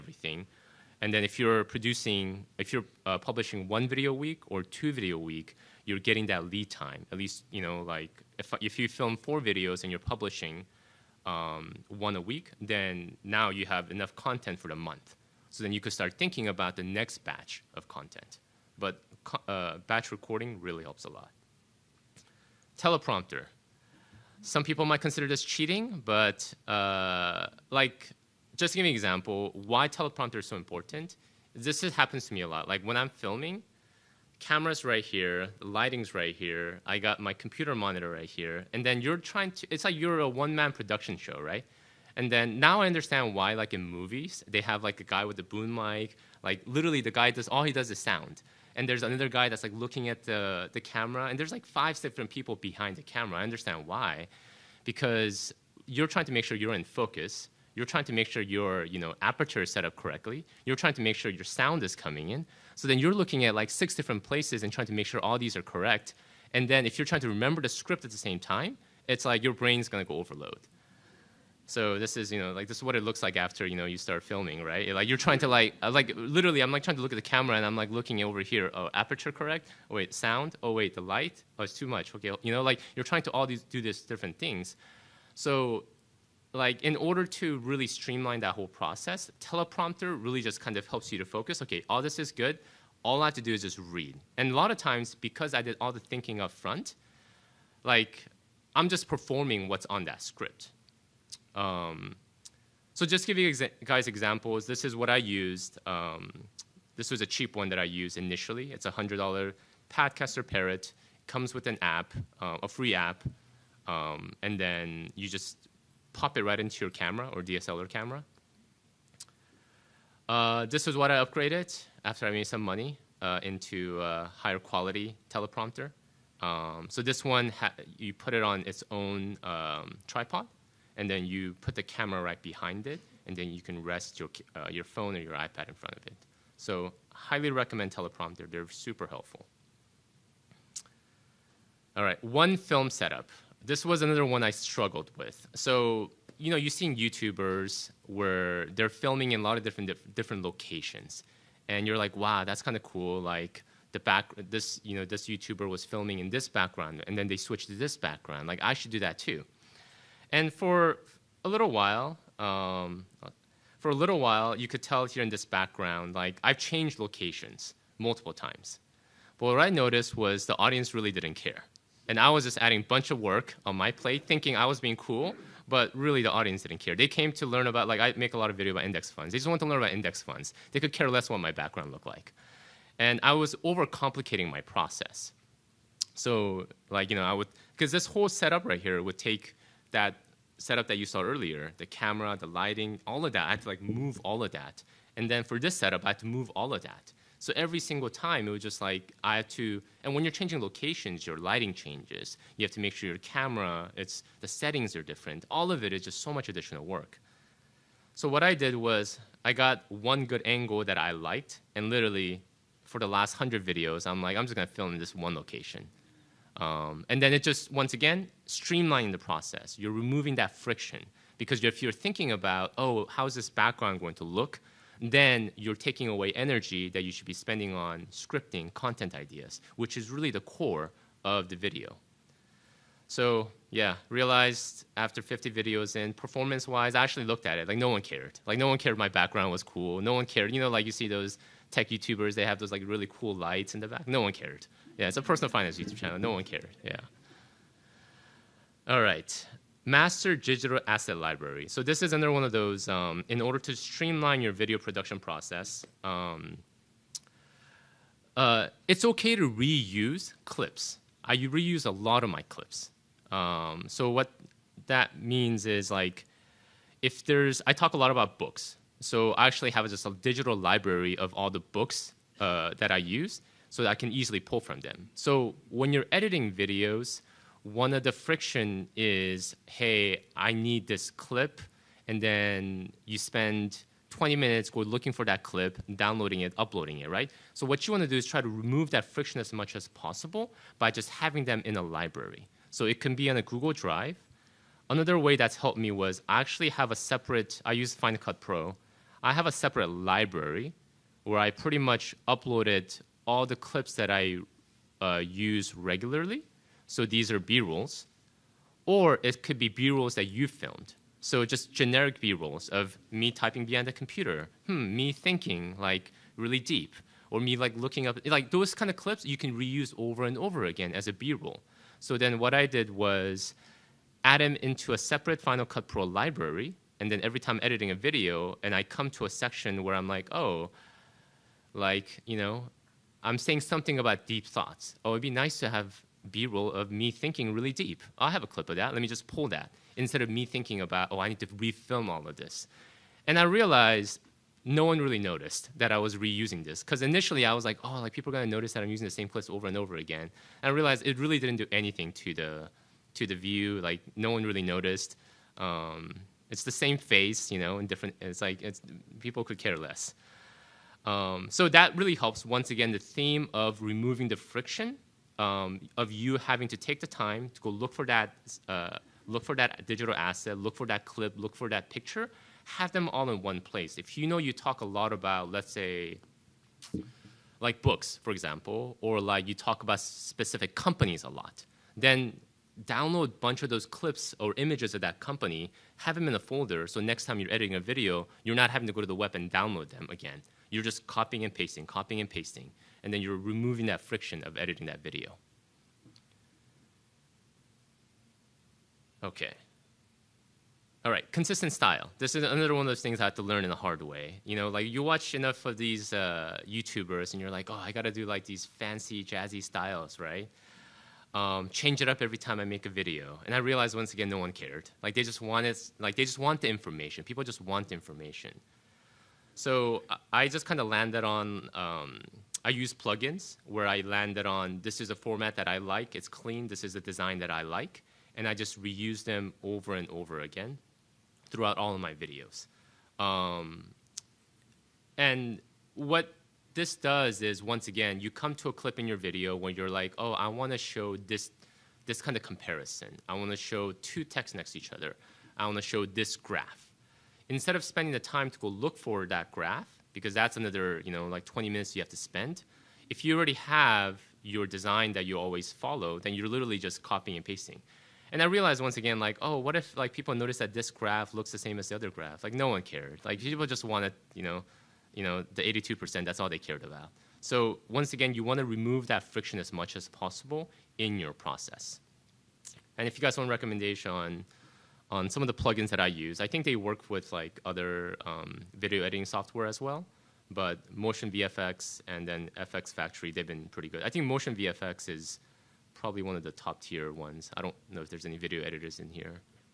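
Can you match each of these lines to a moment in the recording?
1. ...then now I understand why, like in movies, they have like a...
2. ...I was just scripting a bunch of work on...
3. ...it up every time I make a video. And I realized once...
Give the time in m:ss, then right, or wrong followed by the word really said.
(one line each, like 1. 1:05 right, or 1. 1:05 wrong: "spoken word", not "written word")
1. 0:42 right
2. 2:52 wrong: "adding", not "scripting"
3. 6:52 right.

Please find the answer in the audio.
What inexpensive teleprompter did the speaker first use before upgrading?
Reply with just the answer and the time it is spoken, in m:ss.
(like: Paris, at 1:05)
Padcaster Parrot, at 1:49.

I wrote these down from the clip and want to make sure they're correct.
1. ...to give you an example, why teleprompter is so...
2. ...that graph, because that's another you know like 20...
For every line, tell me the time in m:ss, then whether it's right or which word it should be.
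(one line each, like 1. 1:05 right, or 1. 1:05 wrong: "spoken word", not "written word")
1. 0:28 right
2. 7:29 right.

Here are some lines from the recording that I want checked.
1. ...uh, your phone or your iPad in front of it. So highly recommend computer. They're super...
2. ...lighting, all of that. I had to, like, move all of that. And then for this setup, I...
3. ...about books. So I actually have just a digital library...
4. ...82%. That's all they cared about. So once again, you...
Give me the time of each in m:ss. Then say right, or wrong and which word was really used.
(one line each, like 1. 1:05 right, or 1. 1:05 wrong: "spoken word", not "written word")
1. 2:14 wrong: "teleprompter", not "computer"
2. 3:12 right
3. 4:28 right
4. 7:45 right.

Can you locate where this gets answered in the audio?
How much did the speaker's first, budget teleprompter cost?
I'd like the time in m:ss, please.
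1:48.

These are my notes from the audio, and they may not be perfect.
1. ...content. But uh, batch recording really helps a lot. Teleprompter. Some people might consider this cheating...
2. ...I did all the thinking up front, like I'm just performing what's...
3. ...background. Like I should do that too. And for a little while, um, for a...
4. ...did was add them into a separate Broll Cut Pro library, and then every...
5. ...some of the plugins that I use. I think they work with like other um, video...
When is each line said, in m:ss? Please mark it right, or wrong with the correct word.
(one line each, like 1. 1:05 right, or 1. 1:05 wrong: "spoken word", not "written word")
1. 0:17 right
2. 1:35 right
3. 2:37 right
4. 5:22 wrong: "Final", not "Broll"
5. 7:55 right.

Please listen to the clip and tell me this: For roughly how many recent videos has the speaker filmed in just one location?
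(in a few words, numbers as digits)
100.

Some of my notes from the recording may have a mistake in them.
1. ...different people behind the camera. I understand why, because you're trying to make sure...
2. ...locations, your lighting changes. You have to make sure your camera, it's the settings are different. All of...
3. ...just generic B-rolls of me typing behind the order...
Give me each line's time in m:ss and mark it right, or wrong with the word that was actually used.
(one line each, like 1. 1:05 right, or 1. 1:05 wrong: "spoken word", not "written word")
1. 0:51 right
2. 3:20 right
3. 5:11 wrong: "computer", not "order".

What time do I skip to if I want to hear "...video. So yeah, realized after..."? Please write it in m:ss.
3:51.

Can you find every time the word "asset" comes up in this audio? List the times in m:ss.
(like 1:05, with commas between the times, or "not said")
4:10, 6:10.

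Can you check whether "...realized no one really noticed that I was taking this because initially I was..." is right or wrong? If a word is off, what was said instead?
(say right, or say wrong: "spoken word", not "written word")
wrong: "reusing", not "taking".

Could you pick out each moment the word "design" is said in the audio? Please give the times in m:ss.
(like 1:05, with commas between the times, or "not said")
7:06, 7:34.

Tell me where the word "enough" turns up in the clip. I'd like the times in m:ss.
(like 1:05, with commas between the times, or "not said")
0:13, 6:45.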